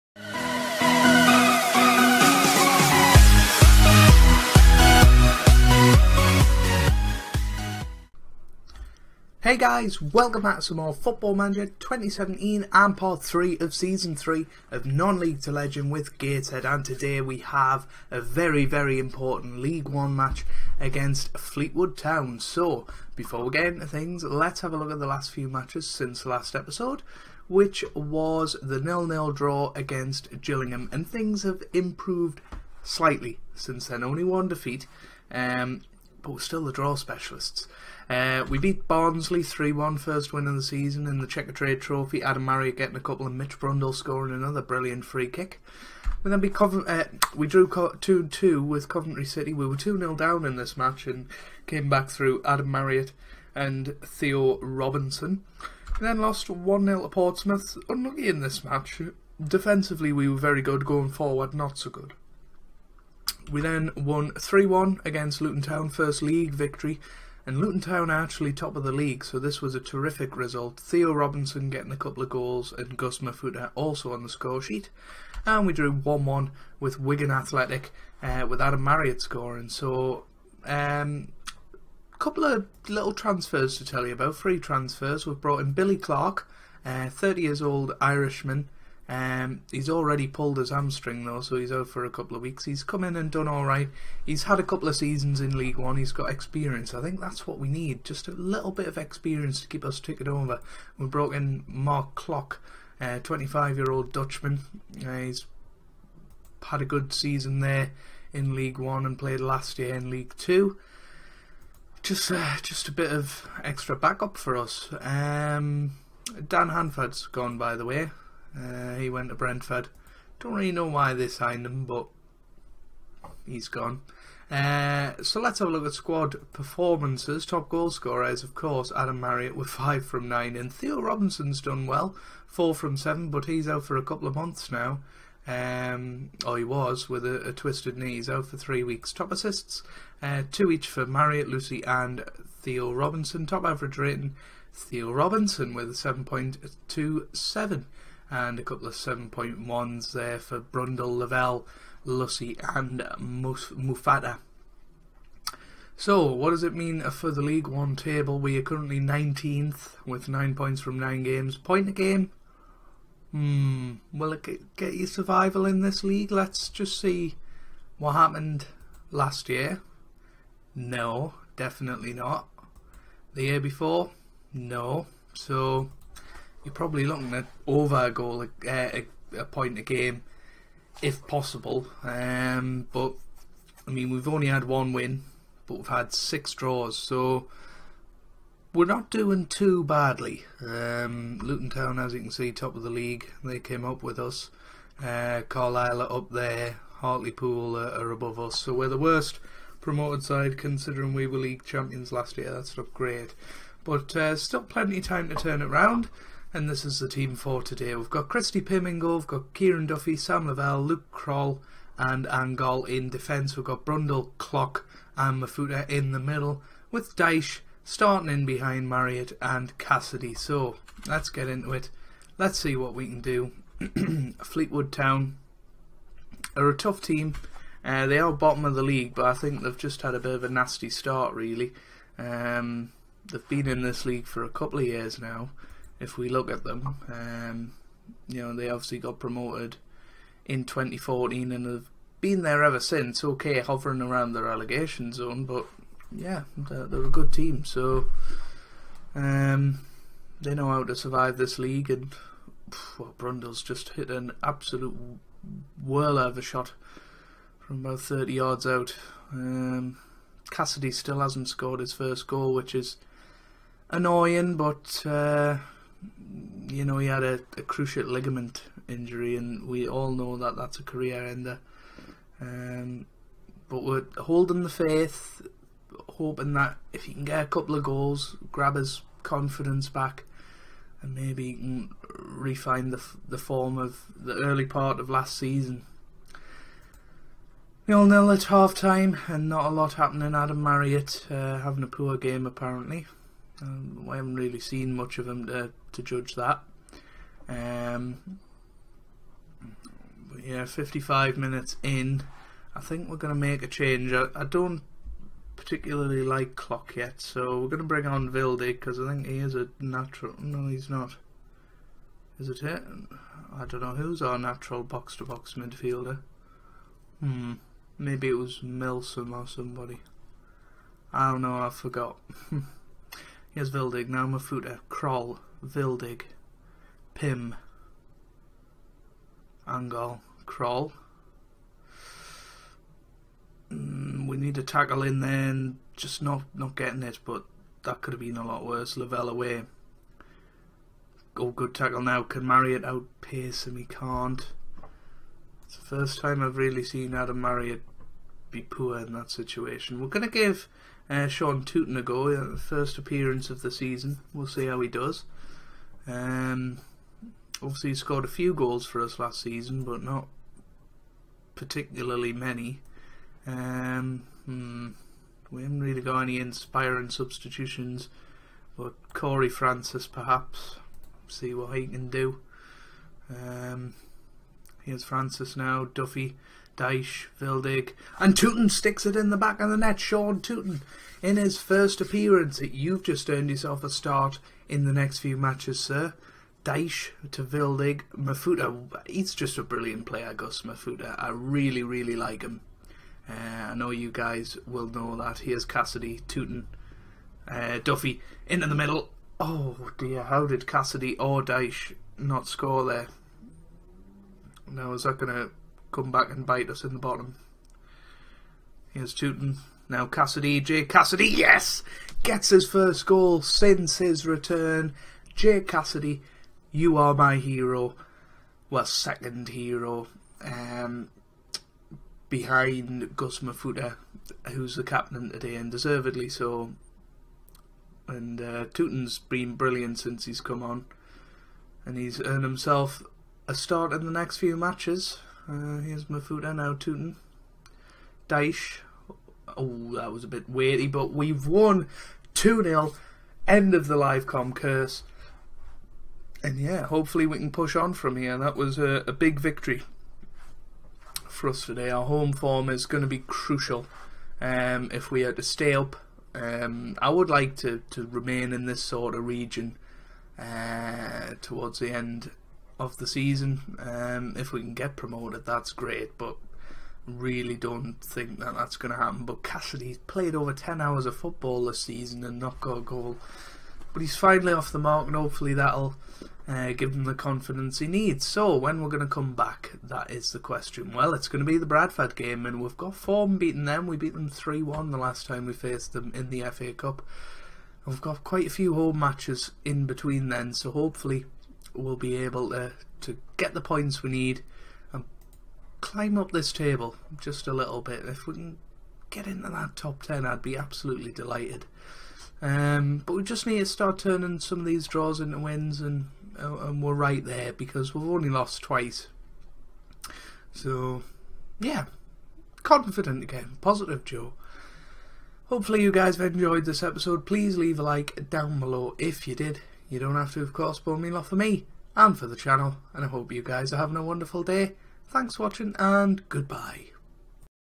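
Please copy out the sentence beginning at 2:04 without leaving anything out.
Uh, so let's have a look at squad performances.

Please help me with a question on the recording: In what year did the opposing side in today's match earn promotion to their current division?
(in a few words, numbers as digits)
2014.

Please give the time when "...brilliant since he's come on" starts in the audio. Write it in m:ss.
7:09.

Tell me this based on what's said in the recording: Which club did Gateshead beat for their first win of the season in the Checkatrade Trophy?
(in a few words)
Barnsley.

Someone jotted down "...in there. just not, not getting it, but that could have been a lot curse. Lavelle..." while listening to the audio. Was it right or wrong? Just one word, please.
wrong.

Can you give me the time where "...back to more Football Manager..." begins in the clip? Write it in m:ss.
0:10.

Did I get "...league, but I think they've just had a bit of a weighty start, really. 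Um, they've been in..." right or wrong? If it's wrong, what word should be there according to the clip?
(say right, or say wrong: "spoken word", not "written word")
wrong: "nasty", not "weighty".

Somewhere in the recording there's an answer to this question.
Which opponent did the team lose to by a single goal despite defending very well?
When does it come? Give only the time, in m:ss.
0:57.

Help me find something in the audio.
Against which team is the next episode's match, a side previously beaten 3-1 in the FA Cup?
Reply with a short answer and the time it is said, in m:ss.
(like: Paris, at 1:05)
Bradford, at 8:01.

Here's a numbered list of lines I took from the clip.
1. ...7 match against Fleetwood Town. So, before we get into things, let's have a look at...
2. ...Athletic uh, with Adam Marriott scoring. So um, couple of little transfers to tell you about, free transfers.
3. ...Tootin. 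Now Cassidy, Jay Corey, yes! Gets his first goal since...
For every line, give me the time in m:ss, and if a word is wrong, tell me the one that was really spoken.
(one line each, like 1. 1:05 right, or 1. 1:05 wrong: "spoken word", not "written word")
1. 0:19 wrong: "1", not "7"
2. 1:17 right
3. 6:49 wrong: "Cassidy", not "Corey".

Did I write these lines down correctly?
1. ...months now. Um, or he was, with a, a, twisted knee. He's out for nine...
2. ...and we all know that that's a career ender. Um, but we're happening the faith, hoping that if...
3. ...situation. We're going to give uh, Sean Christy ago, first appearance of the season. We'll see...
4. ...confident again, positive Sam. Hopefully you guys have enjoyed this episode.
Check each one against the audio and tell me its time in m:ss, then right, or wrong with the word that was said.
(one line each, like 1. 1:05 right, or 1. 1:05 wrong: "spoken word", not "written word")
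1. 2:14 wrong: "three", not "nine"
2. 4:29 wrong: "holding", not "happening"
3. 5:49 wrong: "Tootin", not "Christy"
4. 8:32 wrong: "Joe", not "Sam".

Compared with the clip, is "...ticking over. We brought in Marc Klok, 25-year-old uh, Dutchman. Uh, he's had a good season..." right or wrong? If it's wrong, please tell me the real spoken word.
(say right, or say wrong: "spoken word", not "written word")
right.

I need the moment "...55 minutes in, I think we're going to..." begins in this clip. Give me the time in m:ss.
5:00.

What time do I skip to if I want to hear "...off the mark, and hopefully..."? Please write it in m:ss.
7:54.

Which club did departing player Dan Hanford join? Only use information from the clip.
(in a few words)
Brentford.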